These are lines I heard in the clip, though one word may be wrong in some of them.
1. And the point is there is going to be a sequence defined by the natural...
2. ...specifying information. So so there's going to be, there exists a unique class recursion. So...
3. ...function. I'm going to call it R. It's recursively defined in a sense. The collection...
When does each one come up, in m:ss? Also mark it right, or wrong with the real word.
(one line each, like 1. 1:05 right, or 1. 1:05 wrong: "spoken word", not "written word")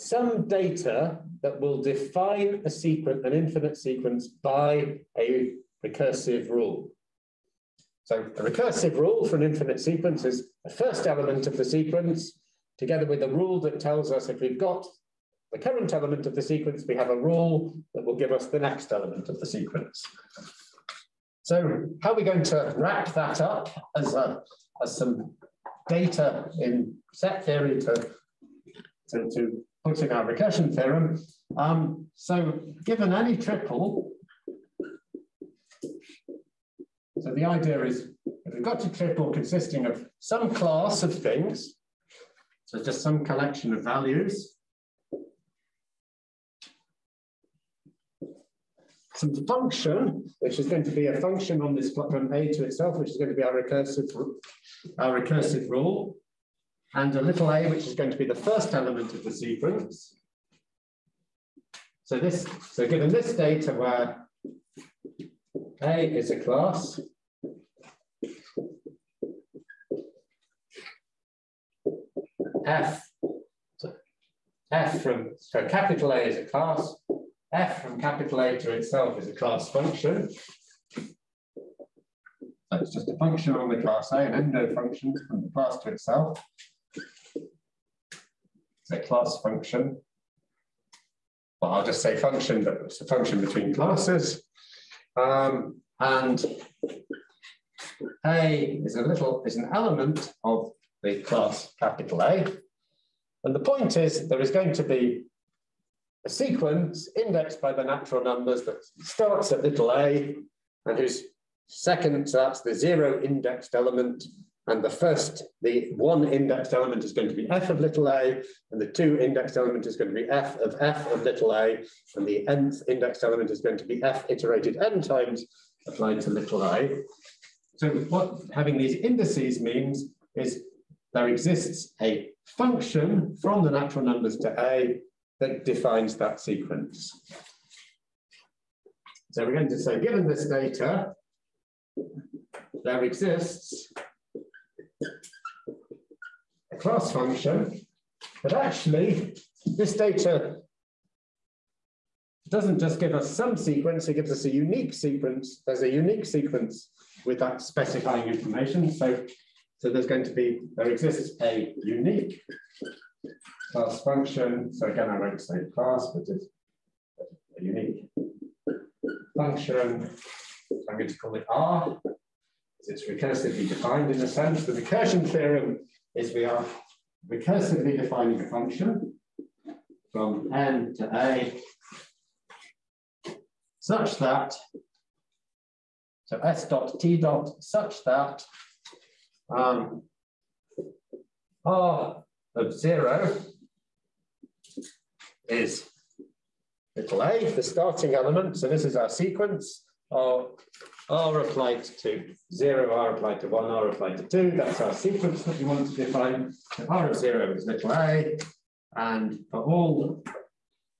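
1. 1:43 wrong: "indexed", not "defined"
2. 2:37 wrong: "function", not "recursion"
3. 2:49 wrong: "recursion", not "collection".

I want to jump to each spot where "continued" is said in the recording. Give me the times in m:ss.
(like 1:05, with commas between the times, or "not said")
not said.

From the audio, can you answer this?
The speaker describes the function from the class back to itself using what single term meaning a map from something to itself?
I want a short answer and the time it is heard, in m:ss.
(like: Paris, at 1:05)
endo function, at 1:24.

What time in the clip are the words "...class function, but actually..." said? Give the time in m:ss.
2:26.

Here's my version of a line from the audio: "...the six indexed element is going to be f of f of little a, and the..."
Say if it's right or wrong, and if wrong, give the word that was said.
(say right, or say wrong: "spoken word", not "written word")
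wrong: "two", not "six".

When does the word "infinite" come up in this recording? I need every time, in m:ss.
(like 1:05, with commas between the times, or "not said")
0:03, 0:09.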